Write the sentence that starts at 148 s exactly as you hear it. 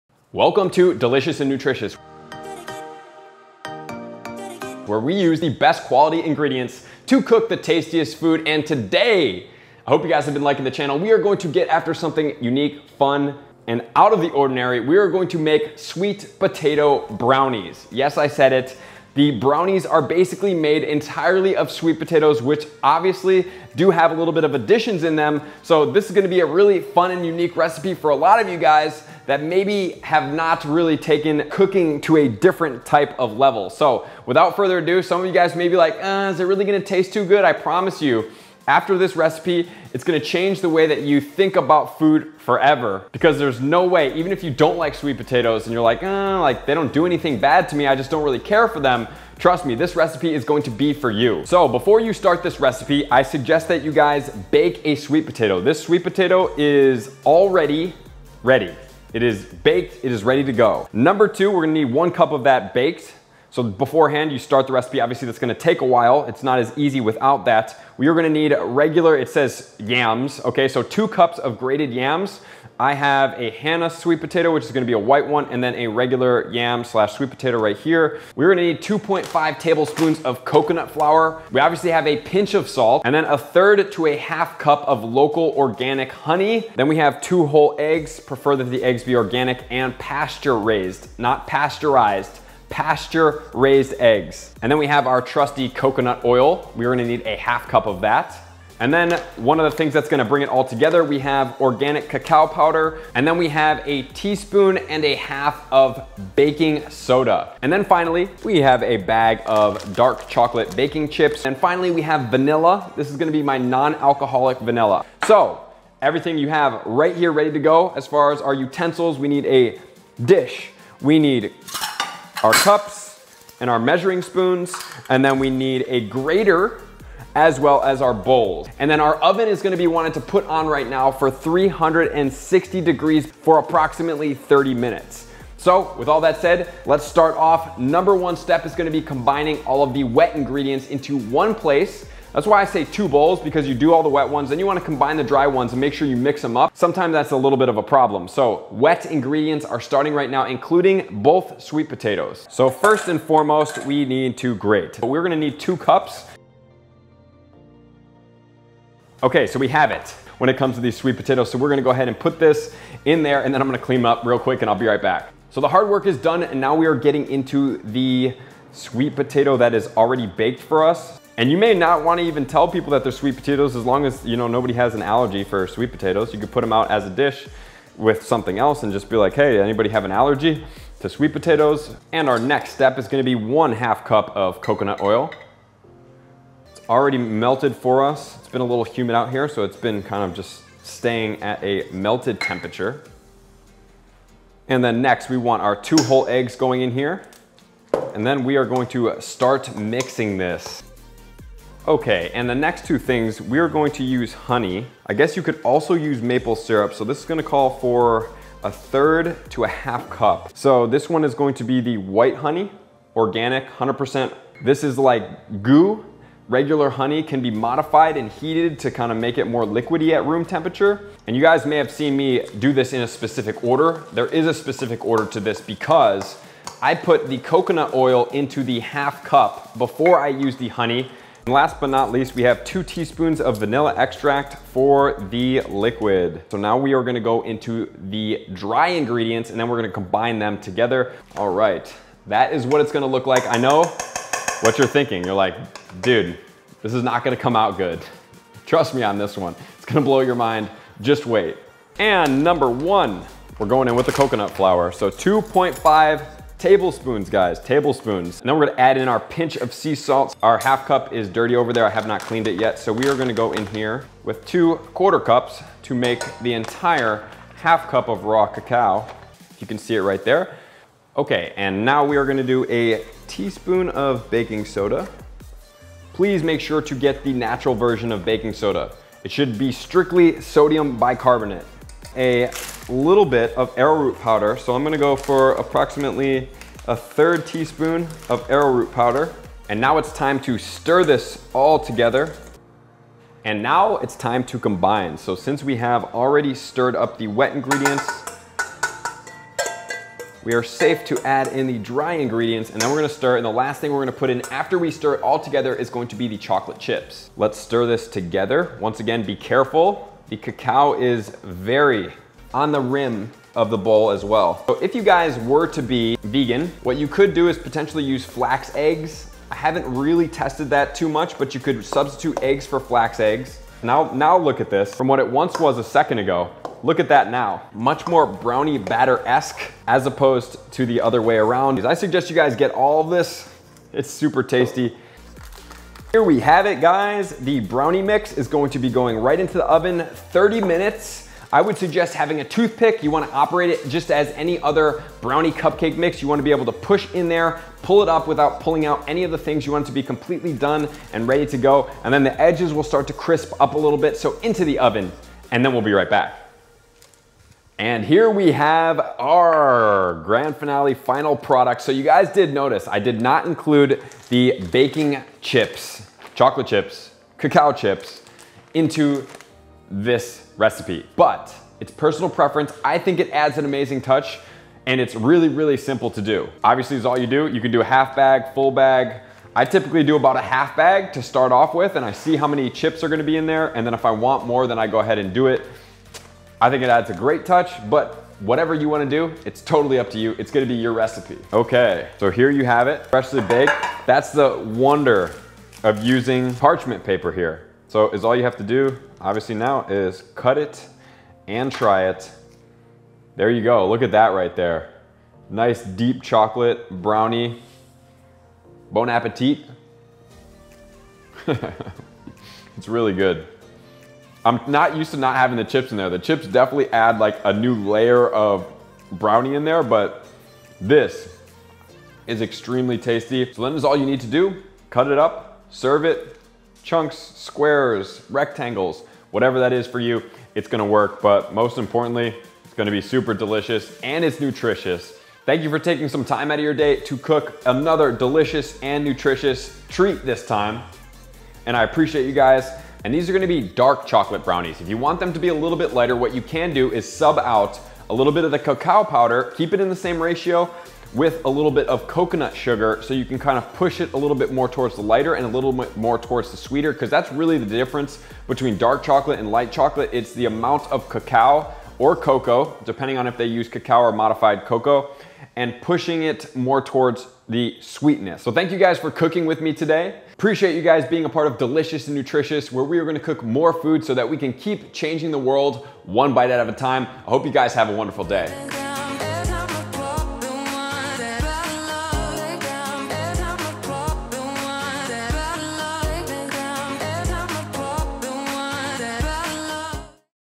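So wet ingredients are starting right now, including both sweet potatoes.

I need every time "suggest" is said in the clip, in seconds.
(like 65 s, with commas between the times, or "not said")
53 s, 331 s, 341 s.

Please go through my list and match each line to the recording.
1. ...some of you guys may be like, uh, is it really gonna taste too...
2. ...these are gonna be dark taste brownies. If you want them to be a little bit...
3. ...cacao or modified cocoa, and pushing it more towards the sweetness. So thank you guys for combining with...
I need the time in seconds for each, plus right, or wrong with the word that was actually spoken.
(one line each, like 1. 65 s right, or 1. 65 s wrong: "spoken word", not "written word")
1. 35 s right
2. 443 s wrong: "chocolate", not "taste"
3. 463 s wrong: "cooking", not "combining".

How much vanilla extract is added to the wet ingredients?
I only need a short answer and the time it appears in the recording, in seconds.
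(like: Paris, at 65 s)
2 teaspoons, at 232 s.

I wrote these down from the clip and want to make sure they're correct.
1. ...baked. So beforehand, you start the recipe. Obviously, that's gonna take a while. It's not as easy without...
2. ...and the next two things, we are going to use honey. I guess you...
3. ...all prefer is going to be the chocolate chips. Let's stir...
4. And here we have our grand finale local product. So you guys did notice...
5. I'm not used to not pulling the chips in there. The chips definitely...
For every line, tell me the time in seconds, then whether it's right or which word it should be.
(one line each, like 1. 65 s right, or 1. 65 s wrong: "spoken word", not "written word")
1. 62 s right
2. 202 s right
3. 305 s wrong: "together", not "prefer"
4. 357 s wrong: "final", not "local"
5. 414 s wrong: "having", not "pulling".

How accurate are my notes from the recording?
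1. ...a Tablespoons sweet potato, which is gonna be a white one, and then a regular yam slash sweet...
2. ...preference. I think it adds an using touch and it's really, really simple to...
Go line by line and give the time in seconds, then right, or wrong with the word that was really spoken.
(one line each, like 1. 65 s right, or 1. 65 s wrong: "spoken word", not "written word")
1. 73 s wrong: "Hannah", not "Tablespoons"
2. 372 s wrong: "amazing", not "using".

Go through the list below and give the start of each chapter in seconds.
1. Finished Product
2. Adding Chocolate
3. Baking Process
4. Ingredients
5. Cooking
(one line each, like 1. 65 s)
1. 358 s
2. 261 s
3. 330 s
4. 20 s
5. 159 s.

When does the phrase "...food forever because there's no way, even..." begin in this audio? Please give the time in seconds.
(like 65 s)
41 s.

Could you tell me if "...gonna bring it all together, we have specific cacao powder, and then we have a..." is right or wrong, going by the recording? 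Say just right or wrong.
wrong.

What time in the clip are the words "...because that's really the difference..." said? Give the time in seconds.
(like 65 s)
456 s.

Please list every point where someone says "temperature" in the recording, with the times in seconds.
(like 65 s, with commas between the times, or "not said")
192 s, 220 s.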